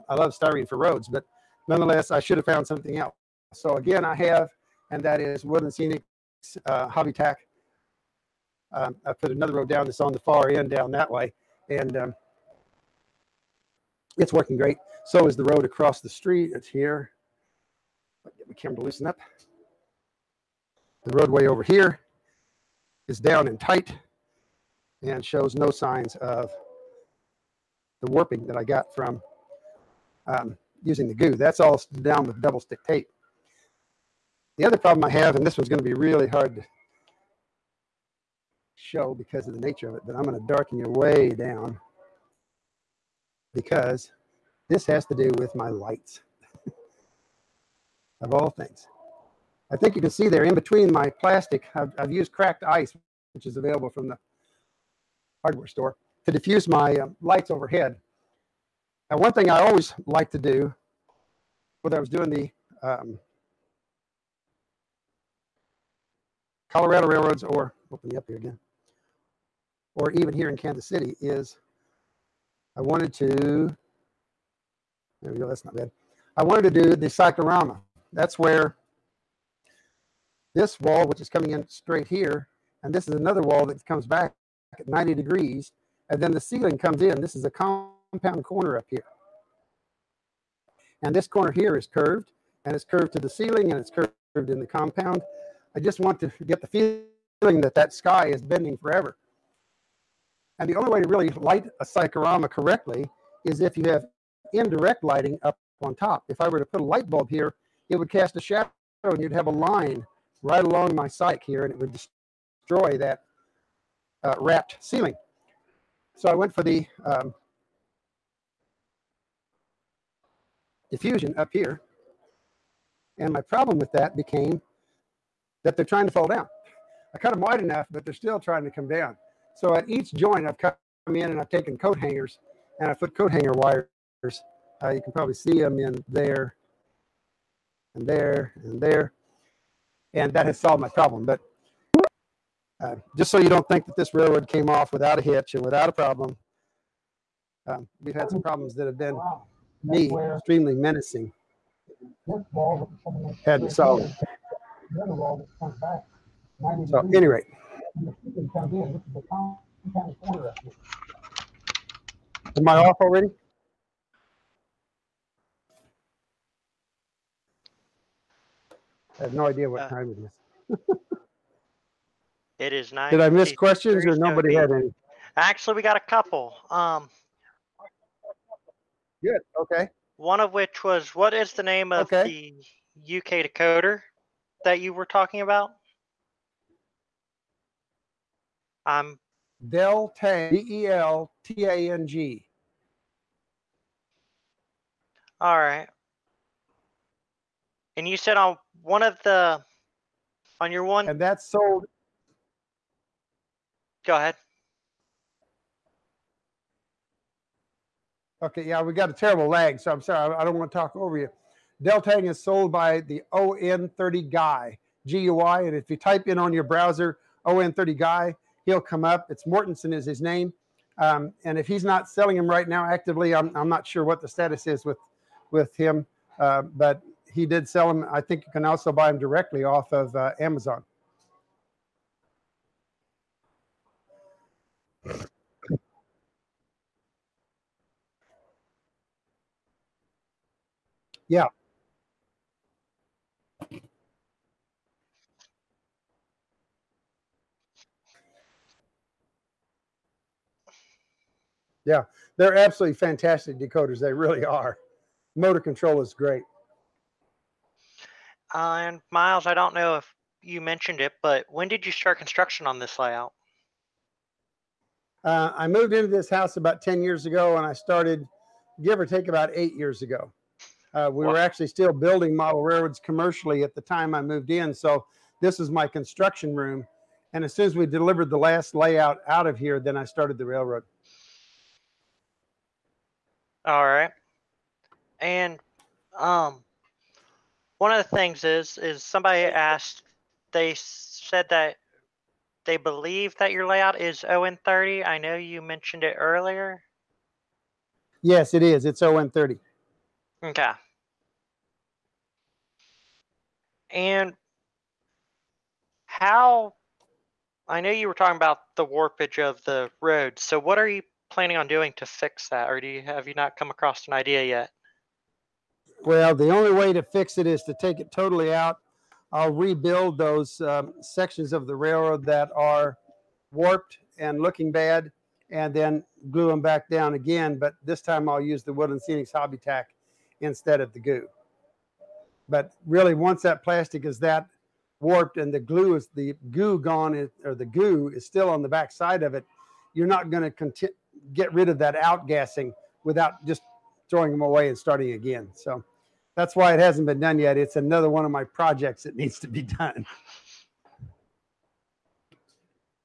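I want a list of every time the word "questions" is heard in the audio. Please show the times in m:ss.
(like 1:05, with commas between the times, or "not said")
2:53.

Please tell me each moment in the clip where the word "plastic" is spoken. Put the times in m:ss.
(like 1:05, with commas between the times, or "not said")
0:51, 5:33.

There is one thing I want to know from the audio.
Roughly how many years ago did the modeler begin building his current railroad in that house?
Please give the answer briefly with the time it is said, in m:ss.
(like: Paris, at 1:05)
8, at 4:29.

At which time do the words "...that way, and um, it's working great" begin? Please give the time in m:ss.
0:10.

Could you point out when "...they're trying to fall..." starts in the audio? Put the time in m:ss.
2:05.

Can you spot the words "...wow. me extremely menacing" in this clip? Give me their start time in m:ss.
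2:29.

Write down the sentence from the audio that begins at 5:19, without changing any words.
I'll rebuild those um, sections of the railroad that are warped and looking bad and then glue them back down again.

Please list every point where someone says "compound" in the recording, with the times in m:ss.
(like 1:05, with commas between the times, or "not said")
1:27, 1:34.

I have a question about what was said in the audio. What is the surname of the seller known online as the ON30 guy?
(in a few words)
Mortensen.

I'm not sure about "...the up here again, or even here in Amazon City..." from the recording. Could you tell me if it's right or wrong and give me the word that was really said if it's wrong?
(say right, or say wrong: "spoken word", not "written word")
wrong: "Kansas", not "Amazon".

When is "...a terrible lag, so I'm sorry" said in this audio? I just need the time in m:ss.
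3:29.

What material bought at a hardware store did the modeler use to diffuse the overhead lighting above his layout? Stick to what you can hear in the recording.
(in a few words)
Cracked ice.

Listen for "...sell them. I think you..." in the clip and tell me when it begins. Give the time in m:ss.
3:47.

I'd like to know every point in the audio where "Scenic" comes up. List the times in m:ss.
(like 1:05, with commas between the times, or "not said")
0:05, 5:29.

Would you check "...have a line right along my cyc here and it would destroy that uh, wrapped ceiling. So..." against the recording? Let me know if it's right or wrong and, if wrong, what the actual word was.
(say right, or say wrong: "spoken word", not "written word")
right.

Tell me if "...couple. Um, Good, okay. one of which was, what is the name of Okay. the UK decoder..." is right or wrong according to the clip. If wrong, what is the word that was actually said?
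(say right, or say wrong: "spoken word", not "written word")
right.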